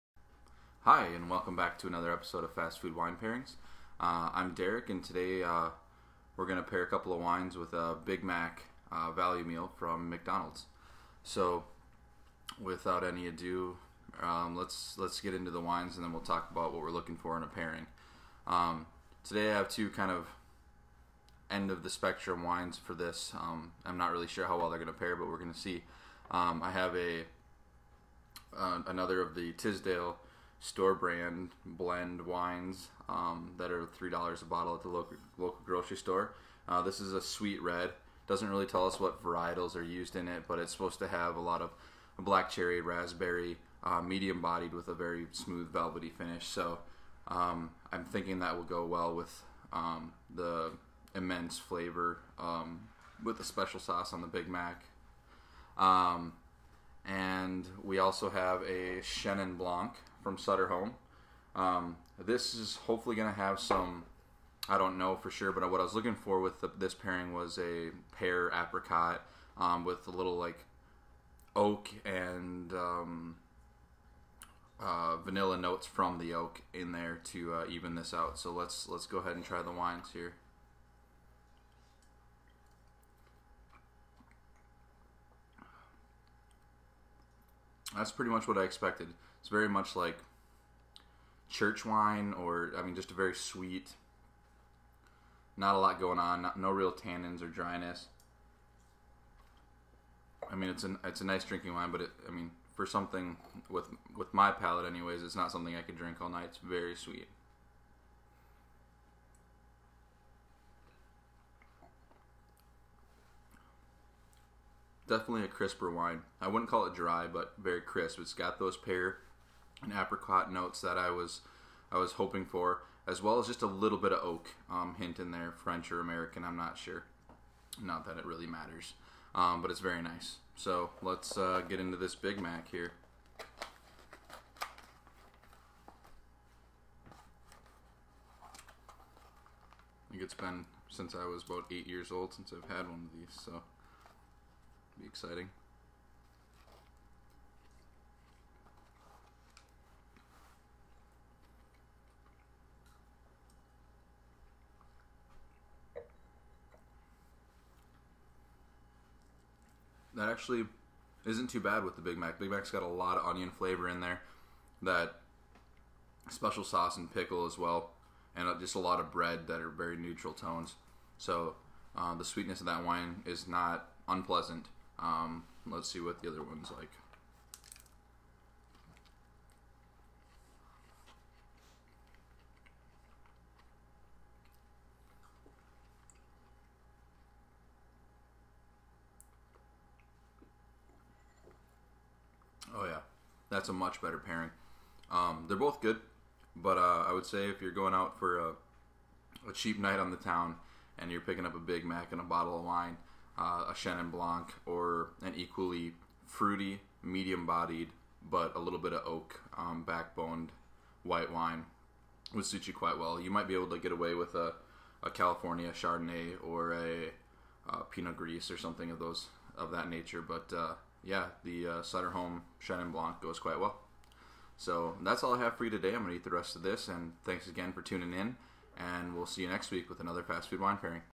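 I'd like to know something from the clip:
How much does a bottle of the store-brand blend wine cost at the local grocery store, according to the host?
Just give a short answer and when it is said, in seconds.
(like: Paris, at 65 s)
$3, at 33 s.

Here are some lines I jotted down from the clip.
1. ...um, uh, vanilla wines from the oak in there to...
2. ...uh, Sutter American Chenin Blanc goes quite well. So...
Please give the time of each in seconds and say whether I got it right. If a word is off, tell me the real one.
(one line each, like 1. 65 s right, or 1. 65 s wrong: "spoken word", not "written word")
1. 72 s wrong: "notes", not "wines"
2. 221 s wrong: "Home", not "American".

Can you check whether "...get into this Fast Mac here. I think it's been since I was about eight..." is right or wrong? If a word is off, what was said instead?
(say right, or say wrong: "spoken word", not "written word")
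wrong: "Big", not "Fast".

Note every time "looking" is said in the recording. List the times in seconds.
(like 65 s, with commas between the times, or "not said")
16 s, 65 s.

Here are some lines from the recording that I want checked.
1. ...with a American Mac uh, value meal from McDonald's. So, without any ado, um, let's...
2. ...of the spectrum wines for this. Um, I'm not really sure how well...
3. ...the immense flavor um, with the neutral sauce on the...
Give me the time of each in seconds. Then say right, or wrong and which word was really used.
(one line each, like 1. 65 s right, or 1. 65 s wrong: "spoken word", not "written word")
1. 7 s wrong: "Big", not "American"
2. 21 s right
3. 50 s wrong: "special", not "neutral".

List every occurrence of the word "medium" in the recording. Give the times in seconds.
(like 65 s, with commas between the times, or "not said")
44 s, 207 s.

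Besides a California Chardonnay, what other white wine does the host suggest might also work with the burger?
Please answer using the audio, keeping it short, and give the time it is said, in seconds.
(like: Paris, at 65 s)
Pinot Gris, at 217 s.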